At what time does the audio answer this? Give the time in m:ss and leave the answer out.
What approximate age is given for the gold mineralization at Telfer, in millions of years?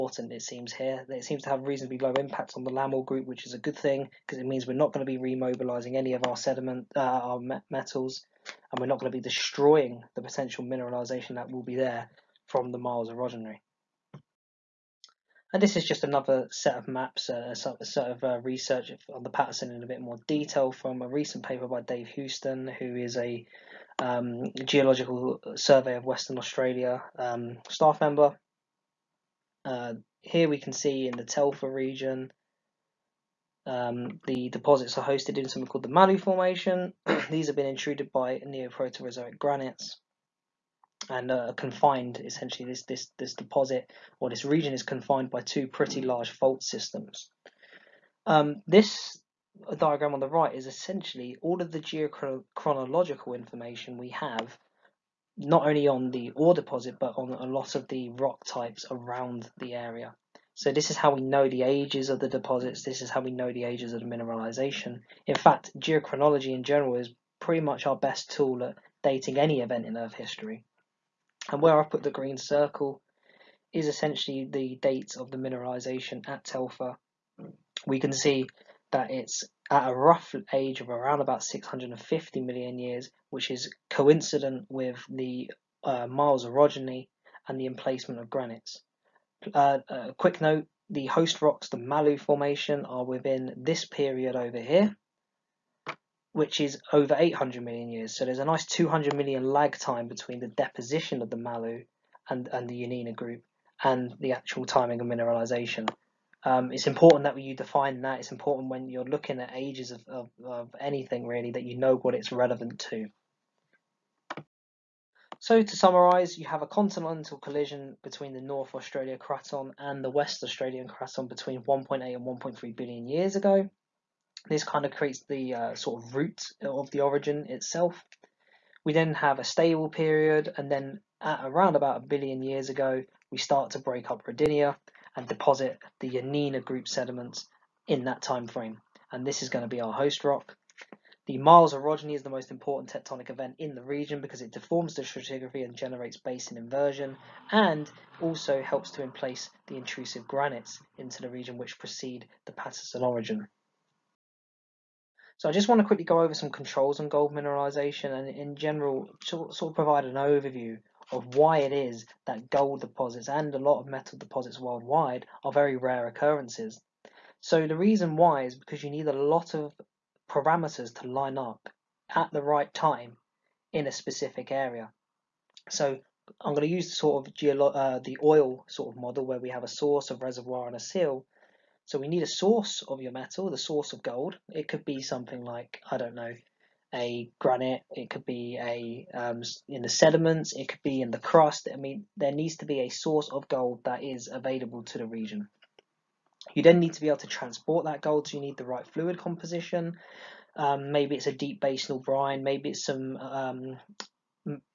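1:21.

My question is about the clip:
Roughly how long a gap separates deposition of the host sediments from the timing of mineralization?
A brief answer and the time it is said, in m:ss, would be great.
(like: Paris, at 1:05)
200 million years, at 1:38.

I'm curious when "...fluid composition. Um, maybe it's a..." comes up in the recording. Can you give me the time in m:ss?
3:18.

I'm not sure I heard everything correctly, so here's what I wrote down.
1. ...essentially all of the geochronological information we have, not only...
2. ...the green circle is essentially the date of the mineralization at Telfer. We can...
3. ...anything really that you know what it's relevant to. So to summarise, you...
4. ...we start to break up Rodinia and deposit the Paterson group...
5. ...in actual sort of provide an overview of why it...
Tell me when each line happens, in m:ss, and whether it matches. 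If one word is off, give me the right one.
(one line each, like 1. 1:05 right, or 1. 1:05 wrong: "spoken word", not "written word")
1. 0:50 right
2. 1:12 right
3. 1:50 right
4. 2:13 wrong: "Yeneena", not "Paterson"
5. 2:38 wrong: "general", not "actual".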